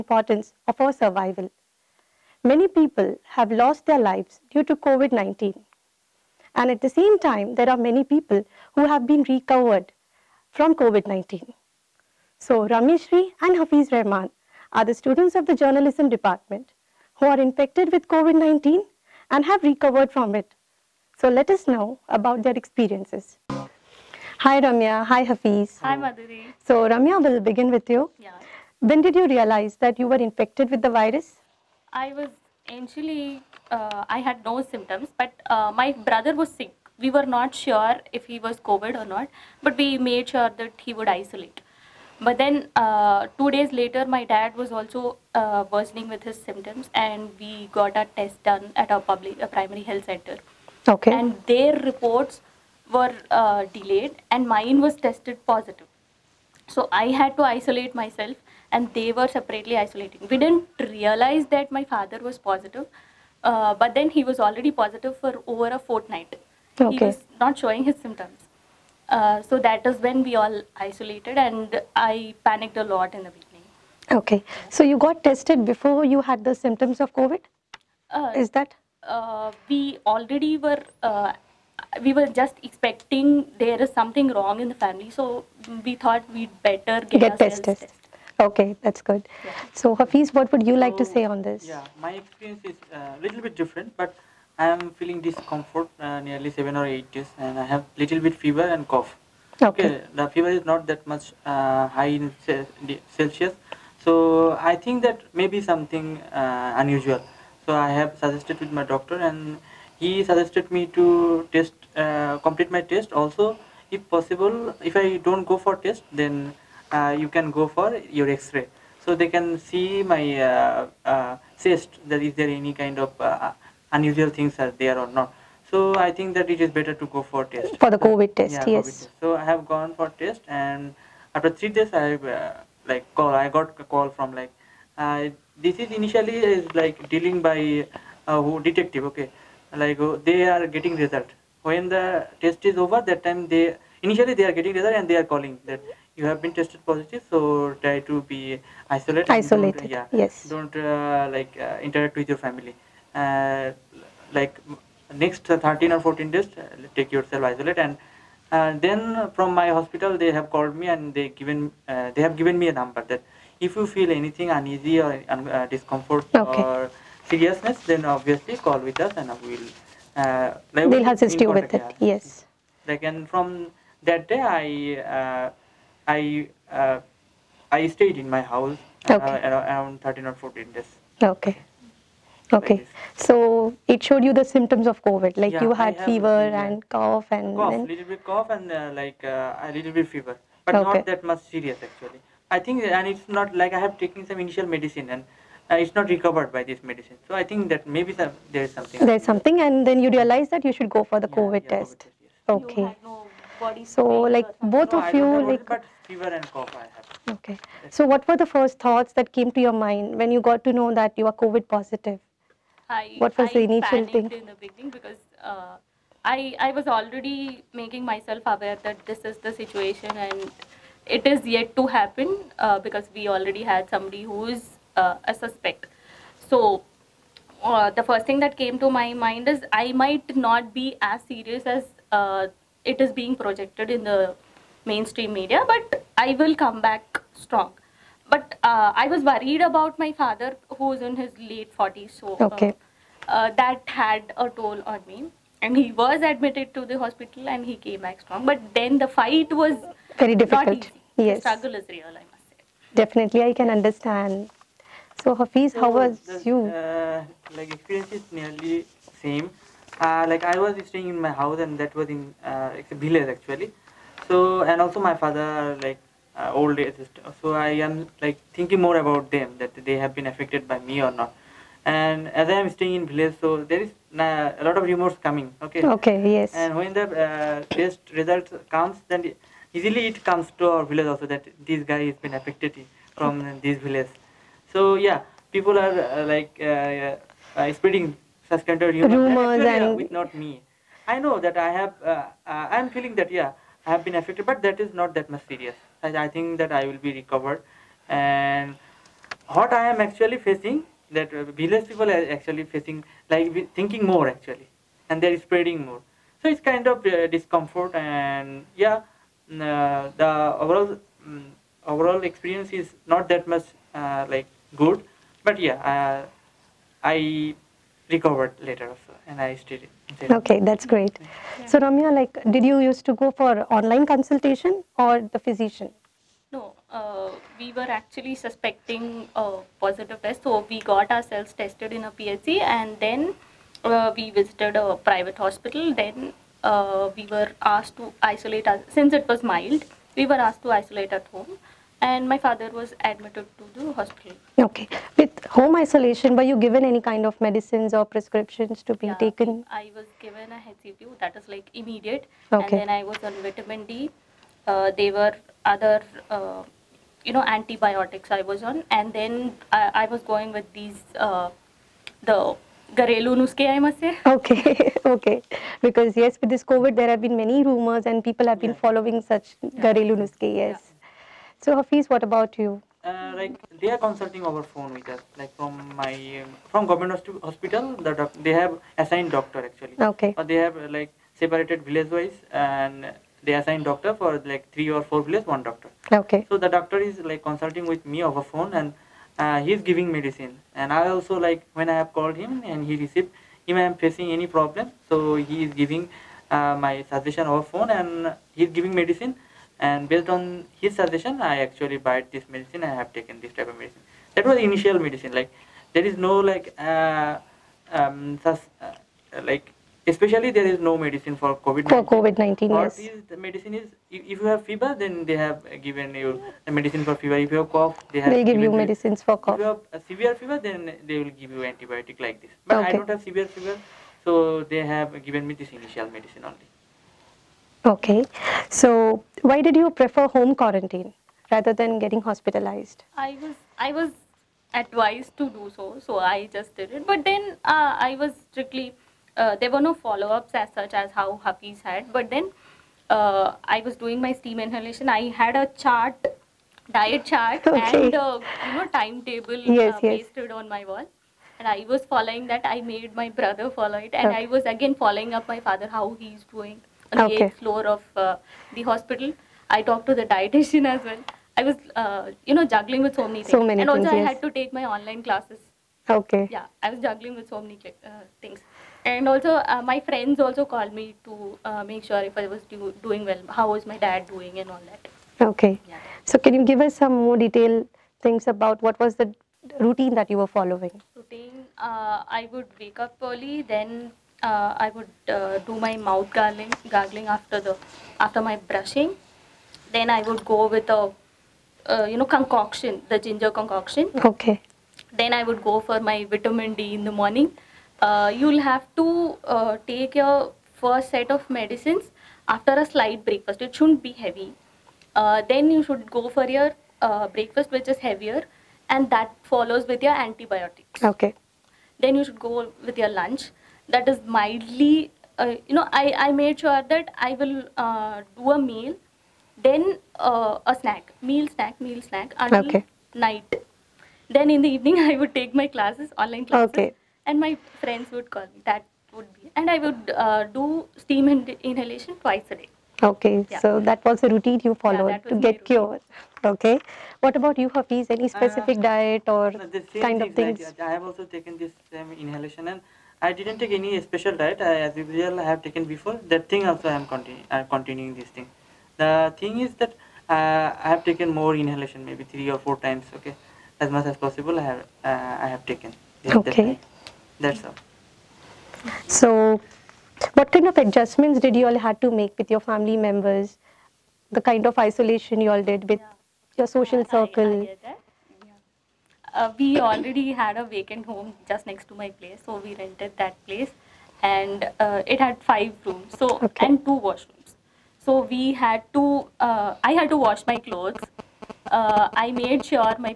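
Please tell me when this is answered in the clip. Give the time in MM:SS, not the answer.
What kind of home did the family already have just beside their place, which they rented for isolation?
09:30.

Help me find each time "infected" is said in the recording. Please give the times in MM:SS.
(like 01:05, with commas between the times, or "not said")
00:17, 00:30.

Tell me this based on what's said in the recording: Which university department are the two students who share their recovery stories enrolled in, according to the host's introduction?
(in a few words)
journalism.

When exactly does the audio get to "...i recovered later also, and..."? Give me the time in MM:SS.
05:17.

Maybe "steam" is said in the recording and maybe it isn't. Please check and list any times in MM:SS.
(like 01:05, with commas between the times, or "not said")
07:24, 08:50.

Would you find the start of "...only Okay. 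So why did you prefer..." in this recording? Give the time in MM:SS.
07:06.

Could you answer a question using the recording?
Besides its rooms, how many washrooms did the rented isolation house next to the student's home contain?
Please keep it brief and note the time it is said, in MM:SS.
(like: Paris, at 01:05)
2, at 09:36.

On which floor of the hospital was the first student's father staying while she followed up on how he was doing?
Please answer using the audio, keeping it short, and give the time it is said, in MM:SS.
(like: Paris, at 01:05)
eighth floor, at 07:37.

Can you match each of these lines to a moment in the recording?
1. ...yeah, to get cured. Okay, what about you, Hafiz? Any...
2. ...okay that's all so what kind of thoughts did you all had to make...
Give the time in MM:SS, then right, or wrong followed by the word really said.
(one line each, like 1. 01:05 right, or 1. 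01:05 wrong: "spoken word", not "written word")
1. 08:55 right
2. 09:16 wrong: "adjustments", not "thoughts".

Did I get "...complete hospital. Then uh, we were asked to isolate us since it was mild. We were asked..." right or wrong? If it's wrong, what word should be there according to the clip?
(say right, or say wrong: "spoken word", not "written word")
wrong: "private", not "complete".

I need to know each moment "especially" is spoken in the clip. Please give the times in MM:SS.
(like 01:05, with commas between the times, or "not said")
06:50.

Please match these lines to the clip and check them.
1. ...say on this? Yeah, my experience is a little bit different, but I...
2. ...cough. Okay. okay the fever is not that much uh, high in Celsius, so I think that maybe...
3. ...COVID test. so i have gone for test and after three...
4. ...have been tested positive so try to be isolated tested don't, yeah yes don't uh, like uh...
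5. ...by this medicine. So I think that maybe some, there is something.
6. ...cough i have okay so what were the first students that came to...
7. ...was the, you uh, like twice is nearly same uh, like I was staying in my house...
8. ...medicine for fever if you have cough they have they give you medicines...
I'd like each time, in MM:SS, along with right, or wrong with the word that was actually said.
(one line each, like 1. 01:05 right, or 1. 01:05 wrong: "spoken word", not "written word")
1. 01:31 right
2. 01:38 right
3. 02:08 right
4. 02:26 wrong: "isolated", not "tested"
5. 03:16 right
6. 03:26 wrong: "thoughts", not "students"
7. 04:15 wrong: "experience", not "twice"
8. 06:56 right.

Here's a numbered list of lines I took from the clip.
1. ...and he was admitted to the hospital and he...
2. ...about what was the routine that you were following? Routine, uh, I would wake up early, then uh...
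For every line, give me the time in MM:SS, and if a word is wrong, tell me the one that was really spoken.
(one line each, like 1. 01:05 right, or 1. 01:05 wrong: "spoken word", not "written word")
1. 04:05 right
2. 07:58 right.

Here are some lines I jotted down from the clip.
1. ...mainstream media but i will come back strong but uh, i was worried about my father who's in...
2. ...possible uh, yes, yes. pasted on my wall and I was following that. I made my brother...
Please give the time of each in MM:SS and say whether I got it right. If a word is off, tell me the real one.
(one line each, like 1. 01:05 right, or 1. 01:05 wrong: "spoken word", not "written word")
1. 03:54 right
2. 07:28 wrong: "timetable", not "possible".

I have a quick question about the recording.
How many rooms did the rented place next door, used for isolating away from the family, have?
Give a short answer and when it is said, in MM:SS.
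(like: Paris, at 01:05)
5, at 09:35.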